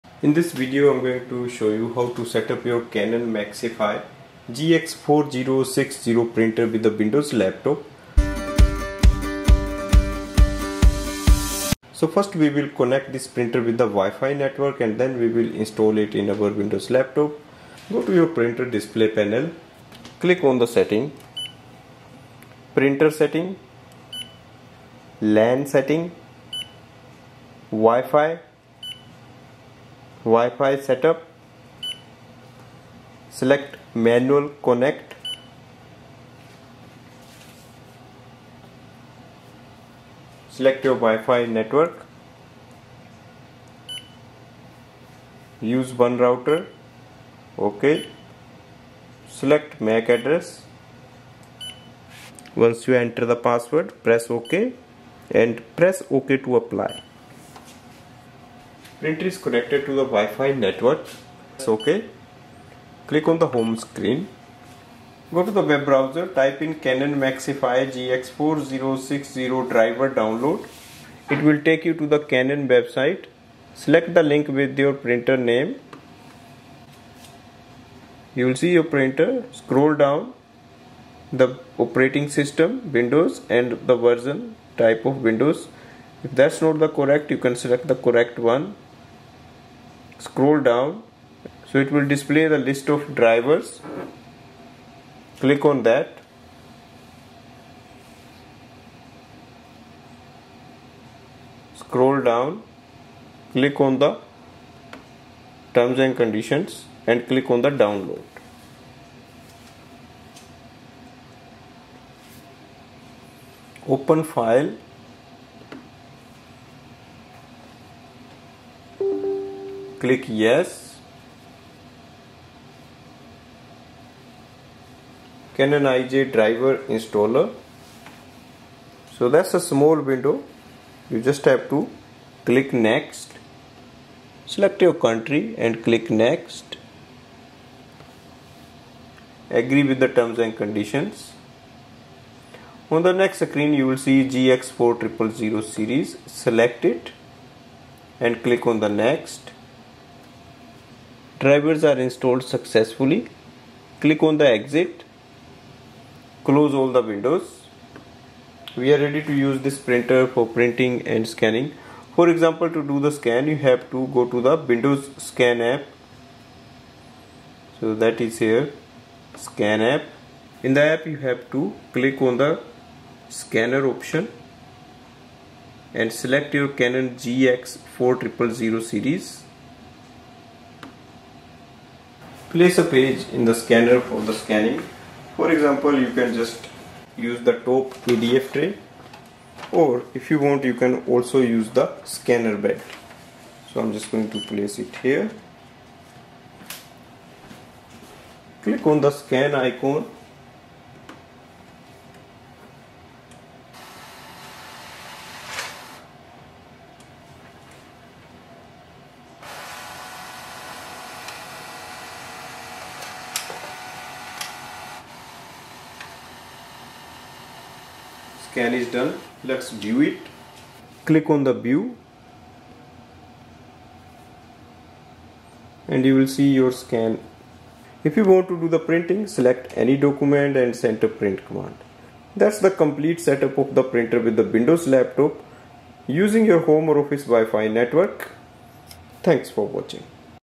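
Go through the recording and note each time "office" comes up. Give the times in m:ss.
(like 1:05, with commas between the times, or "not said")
3:57.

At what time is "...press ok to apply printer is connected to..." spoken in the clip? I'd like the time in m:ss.
0:55.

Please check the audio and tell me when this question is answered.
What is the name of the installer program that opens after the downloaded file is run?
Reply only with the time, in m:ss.
2:05.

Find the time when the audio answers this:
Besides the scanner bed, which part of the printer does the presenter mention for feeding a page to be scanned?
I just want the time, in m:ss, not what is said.
3:07.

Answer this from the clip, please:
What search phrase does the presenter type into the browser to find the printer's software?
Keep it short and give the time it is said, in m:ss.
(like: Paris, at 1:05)
Canon Maxify GX4060 driver, at 1:06.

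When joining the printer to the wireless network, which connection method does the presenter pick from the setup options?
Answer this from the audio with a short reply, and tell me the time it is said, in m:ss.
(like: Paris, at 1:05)
Manual connect, at 0:34.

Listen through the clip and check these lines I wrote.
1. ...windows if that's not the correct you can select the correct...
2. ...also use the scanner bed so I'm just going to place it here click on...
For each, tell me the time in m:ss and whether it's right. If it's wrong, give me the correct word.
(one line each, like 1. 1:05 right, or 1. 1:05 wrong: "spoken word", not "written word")
1. 1:25 right
2. 3:11 right.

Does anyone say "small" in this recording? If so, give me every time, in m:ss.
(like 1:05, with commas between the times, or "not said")
2:09.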